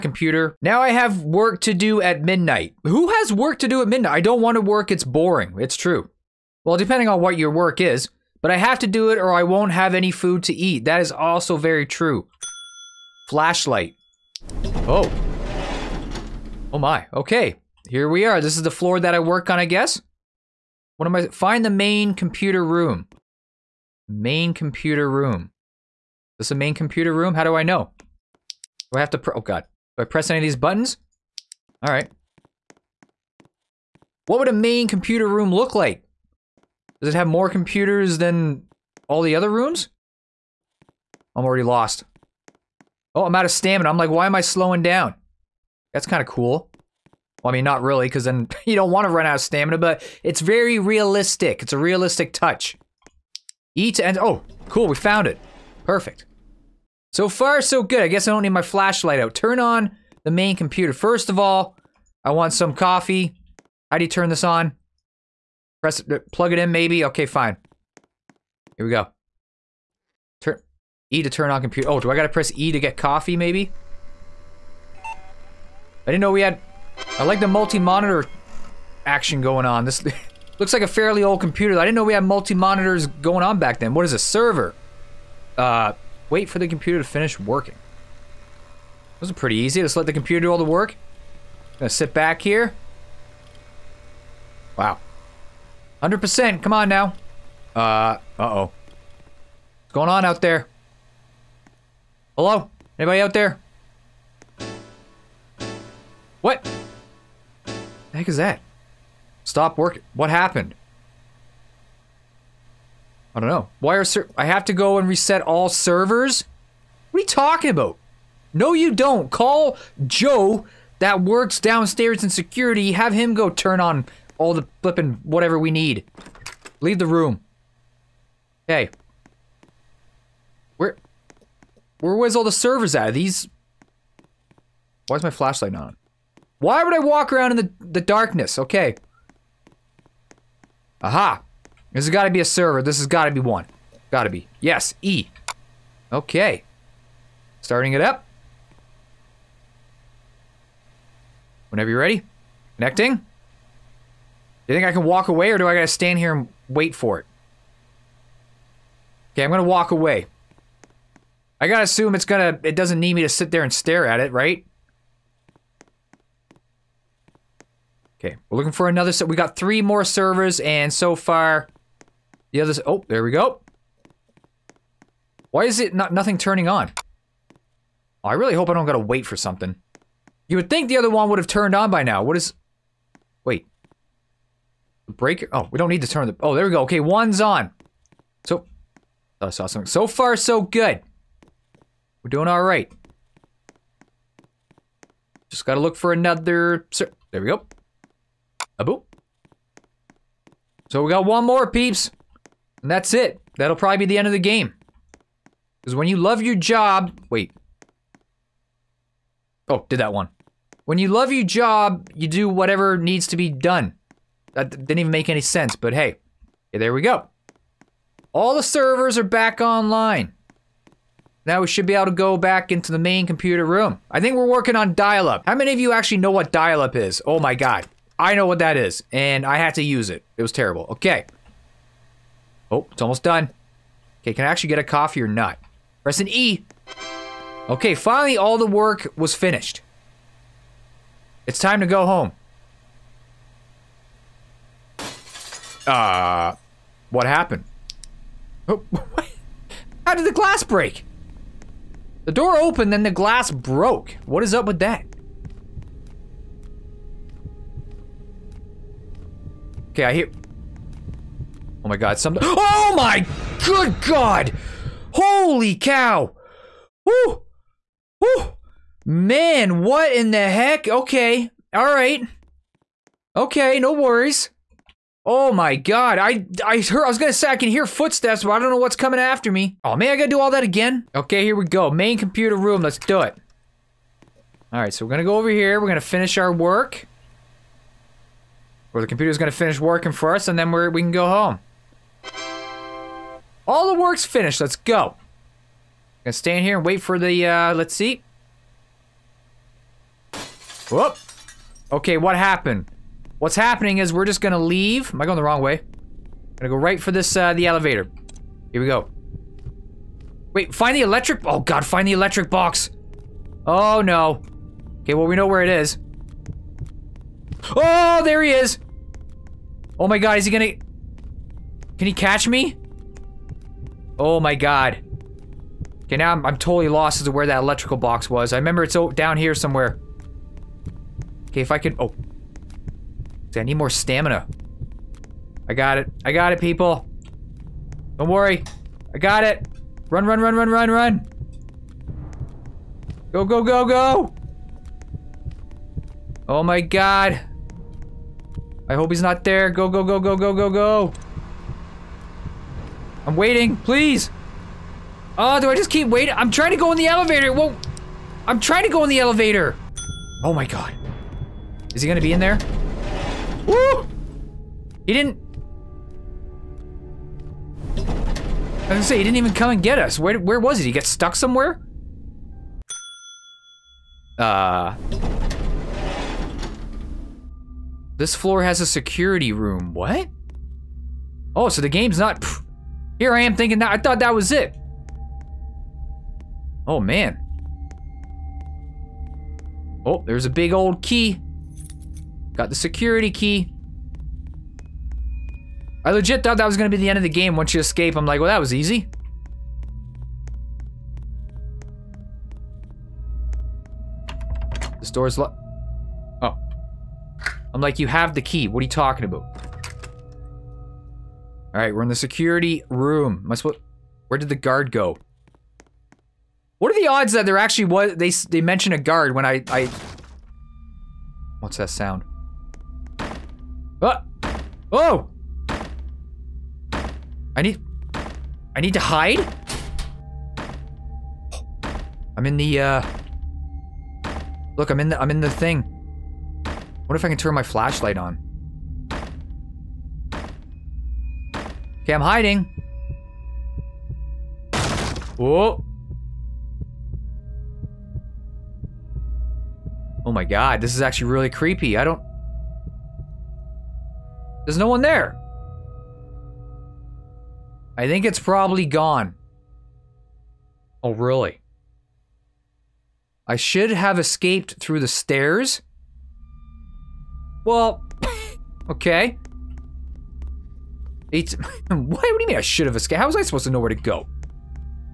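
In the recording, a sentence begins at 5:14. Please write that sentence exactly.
Okay, well we know where it is.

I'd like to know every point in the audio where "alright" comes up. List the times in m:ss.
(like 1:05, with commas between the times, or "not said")
4:31, 4:44.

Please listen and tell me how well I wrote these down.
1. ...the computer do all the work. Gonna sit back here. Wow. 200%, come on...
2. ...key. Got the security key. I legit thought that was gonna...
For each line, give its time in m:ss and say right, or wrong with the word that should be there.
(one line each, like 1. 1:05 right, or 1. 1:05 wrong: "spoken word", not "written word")
1. 1:30 wrong: "100", not "200"
2. 6:31 right.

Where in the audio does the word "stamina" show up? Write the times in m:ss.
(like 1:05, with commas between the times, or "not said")
0:43, 0:49, 5:33.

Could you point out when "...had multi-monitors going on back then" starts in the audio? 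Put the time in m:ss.
1:22.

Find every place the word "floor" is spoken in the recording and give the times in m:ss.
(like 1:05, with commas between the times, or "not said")
0:18, 6:18.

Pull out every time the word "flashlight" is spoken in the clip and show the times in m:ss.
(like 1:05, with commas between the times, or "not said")
0:13, 0:58, 2:15, 7:17.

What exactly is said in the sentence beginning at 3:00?
You would think the other one would have turned on by now.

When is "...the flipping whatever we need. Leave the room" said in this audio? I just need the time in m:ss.
2:04.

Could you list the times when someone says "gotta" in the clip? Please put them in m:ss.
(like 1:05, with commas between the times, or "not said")
1:12, 2:35, 2:41, 2:58, 3:15, 4:40.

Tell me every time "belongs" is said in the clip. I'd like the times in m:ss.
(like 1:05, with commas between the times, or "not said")
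not said.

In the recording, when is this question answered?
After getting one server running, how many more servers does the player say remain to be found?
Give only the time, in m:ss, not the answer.
2:49.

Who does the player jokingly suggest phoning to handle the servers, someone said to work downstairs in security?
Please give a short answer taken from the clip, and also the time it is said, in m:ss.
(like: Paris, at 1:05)
Joe, at 1:59.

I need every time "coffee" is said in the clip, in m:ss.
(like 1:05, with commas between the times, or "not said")
1:02, 1:12, 3:54.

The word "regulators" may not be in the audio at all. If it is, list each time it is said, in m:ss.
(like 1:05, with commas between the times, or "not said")
not said.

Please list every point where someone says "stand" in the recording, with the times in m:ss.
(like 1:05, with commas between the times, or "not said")
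2:35.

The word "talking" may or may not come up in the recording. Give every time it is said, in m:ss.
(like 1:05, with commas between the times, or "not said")
1:57, 6:48.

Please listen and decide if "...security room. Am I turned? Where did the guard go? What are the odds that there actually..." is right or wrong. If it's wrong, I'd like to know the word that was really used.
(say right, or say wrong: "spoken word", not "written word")
wrong: "supposed", not "turned".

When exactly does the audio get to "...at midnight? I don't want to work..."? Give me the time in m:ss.
0:03.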